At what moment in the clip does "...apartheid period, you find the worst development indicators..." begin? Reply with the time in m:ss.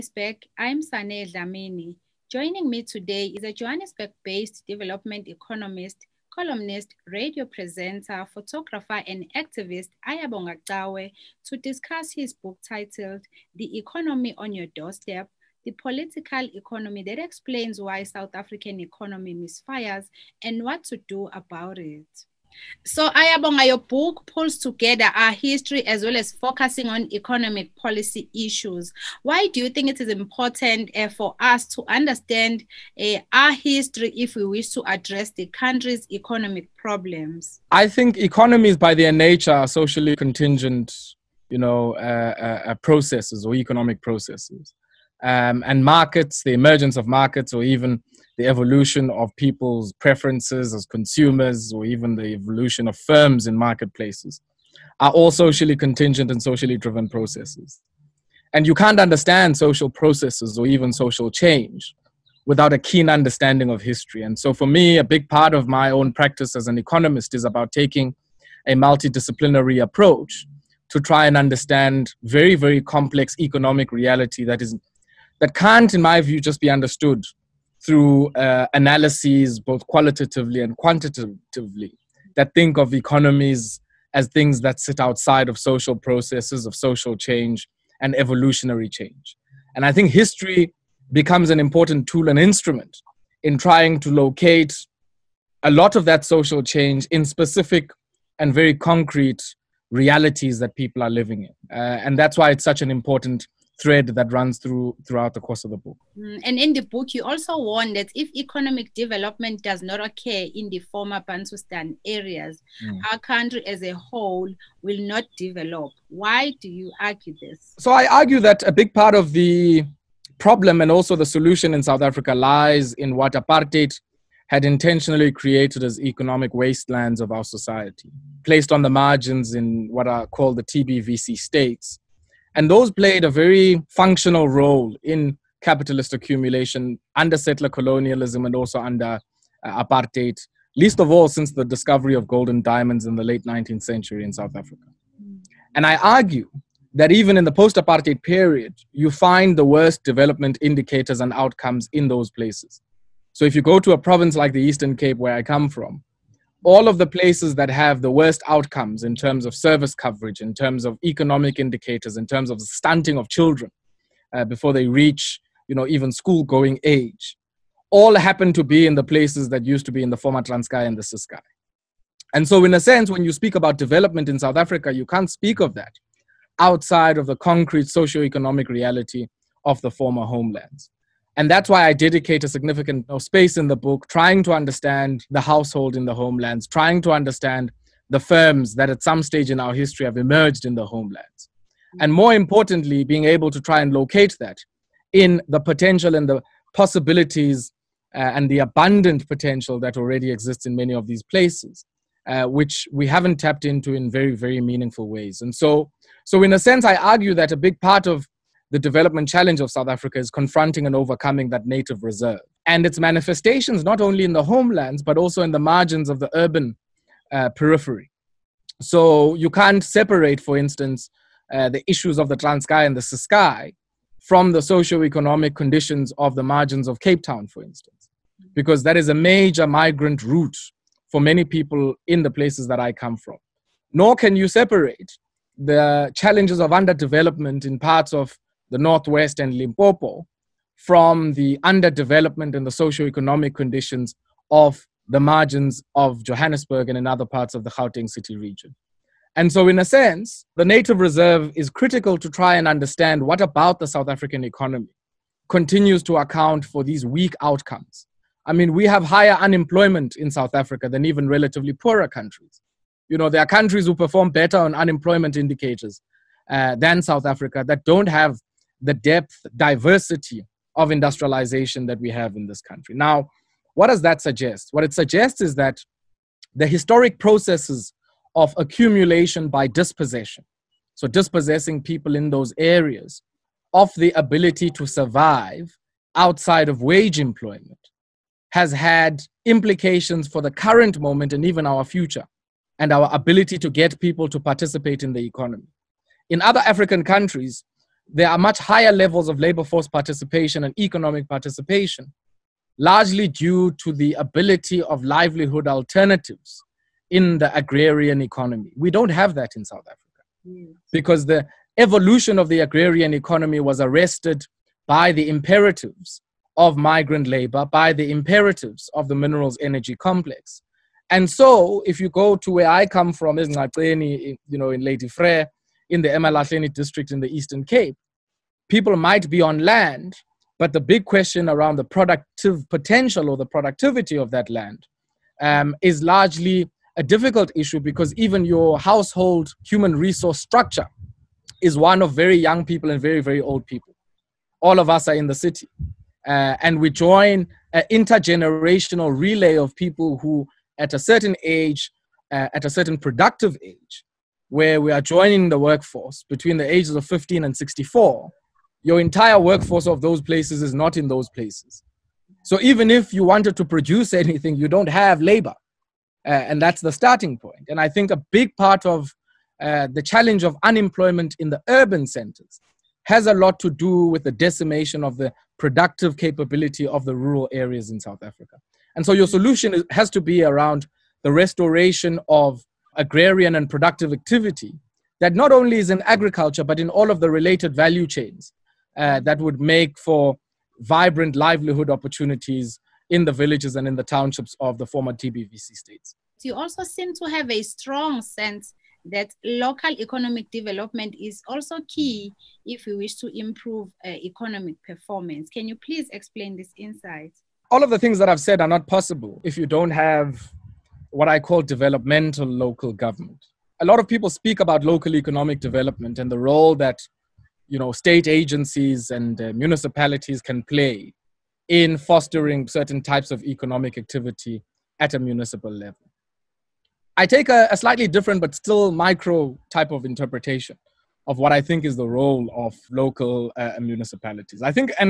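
2:27.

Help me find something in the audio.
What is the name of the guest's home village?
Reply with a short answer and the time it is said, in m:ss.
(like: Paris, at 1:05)
Ngaceni, at 5:23.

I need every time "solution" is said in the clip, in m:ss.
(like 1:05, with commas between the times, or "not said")
2:01, 6:19.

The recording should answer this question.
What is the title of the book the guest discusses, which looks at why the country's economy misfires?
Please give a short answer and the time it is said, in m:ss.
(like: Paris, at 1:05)
The Economy on Your Doorstep, at 0:13.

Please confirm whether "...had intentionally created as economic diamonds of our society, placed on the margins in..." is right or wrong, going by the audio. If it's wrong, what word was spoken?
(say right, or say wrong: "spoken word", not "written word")
wrong: "wastelands", not "diamonds".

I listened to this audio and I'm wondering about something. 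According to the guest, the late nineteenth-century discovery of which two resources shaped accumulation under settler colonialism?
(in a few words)
gold and diamonds.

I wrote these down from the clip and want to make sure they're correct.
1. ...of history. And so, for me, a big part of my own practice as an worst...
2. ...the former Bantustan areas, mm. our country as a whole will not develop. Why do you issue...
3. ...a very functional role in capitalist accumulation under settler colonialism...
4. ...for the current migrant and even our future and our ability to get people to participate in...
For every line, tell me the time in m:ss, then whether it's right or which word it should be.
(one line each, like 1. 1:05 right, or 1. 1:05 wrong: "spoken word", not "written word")
1. 1:03 wrong: "economist", not "worst"
2. 1:50 wrong: "argue", not "issue"
3. 2:13 right
4. 4:50 wrong: "moment", not "migrant".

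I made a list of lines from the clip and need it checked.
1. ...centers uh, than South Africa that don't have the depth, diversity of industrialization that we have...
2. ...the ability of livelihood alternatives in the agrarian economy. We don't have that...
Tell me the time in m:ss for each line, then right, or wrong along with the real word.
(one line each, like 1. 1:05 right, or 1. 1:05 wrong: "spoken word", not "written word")
1. 4:25 wrong: "indicators", not "centers"
2. 5:03 right.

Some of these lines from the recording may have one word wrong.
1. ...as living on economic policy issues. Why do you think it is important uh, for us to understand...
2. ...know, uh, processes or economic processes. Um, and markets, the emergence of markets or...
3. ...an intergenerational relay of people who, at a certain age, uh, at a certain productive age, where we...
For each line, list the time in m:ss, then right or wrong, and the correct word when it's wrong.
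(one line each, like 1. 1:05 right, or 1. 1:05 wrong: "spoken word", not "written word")
1. 0:26 wrong: "focusing", not "living"
2. 0:41 right
3. 5:47 right.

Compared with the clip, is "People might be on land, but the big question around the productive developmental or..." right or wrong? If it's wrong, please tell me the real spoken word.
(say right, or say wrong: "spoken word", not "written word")
wrong: "potential", not "developmental".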